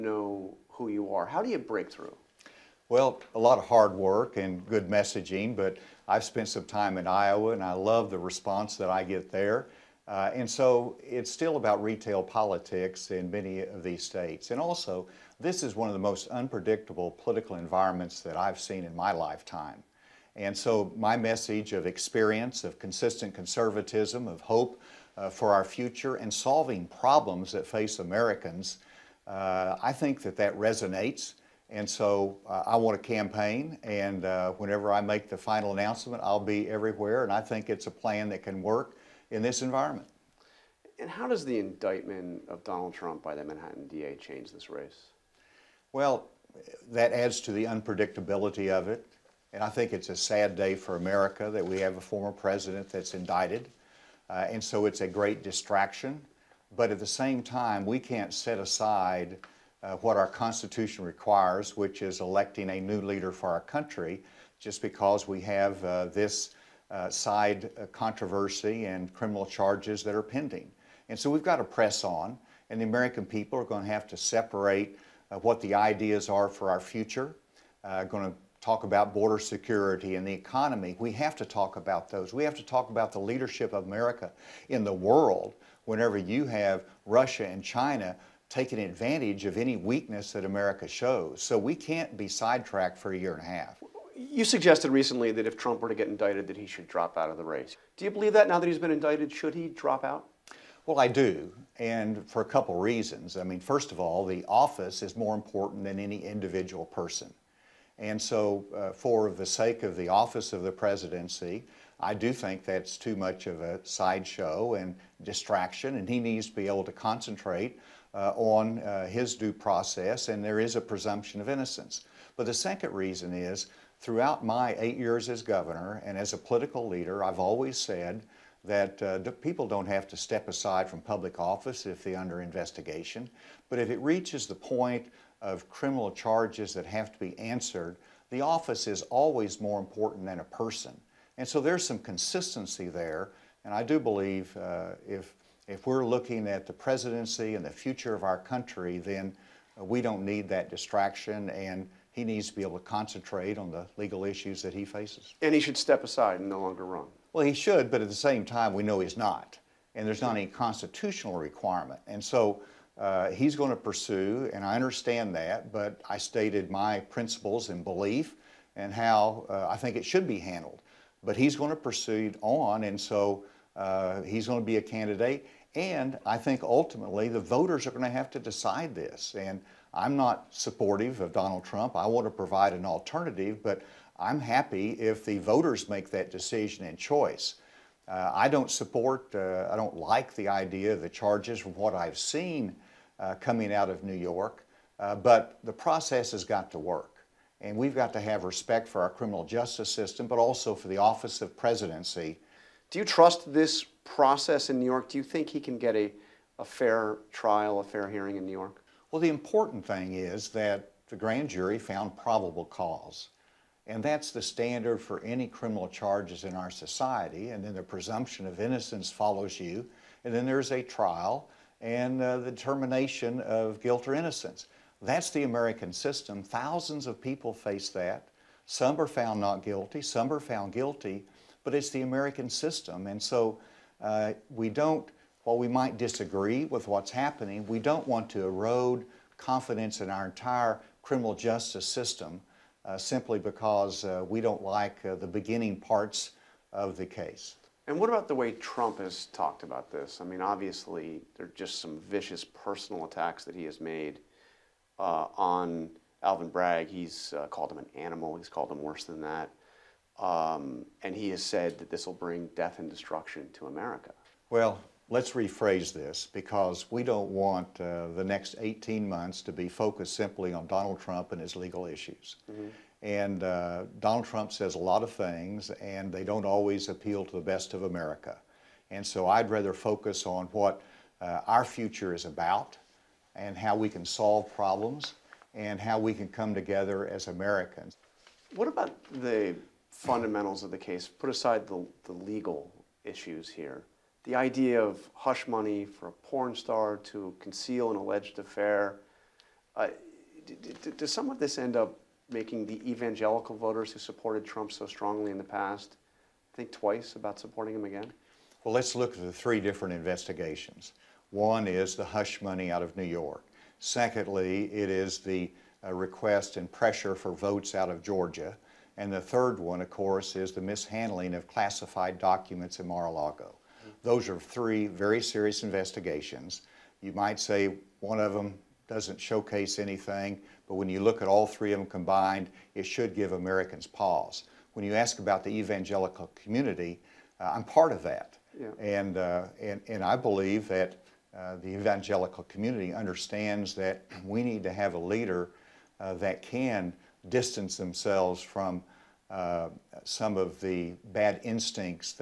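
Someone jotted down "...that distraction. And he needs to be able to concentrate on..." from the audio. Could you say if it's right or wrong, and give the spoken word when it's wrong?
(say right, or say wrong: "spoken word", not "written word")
right.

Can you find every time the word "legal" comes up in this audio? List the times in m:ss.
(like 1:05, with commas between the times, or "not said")
2:33, 4:31, 4:52.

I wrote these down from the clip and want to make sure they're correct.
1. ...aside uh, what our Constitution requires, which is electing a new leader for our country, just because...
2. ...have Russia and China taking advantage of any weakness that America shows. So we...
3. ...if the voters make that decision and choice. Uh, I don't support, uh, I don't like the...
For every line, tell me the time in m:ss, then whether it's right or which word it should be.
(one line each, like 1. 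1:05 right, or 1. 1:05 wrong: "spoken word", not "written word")
1. 0:58 right
2. 1:26 right
3. 3:04 right.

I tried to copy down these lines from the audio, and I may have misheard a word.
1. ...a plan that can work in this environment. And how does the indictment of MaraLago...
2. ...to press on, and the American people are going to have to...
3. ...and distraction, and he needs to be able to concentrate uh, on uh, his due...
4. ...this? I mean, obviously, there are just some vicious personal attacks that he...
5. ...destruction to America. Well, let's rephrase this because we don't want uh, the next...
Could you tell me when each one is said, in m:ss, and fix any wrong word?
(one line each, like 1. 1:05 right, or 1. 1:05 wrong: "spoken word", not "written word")
1. 0:37 wrong: "Donald", not "MaraLago"
2. 1:11 right
3. 1:54 right
4. 4:09 right
5. 4:22 right.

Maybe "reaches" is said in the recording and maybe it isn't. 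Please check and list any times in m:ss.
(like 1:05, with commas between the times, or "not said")
2:13.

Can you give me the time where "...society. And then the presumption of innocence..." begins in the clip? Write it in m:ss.
3:36.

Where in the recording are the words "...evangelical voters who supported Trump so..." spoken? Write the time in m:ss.
5:02.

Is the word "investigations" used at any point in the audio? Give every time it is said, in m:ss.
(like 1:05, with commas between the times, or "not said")
2:12, 5:09, 5:25.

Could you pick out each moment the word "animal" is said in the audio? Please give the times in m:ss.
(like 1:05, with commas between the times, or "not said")
4:17.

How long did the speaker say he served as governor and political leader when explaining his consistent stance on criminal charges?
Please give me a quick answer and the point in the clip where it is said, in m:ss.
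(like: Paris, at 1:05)
8 years, at 2:04.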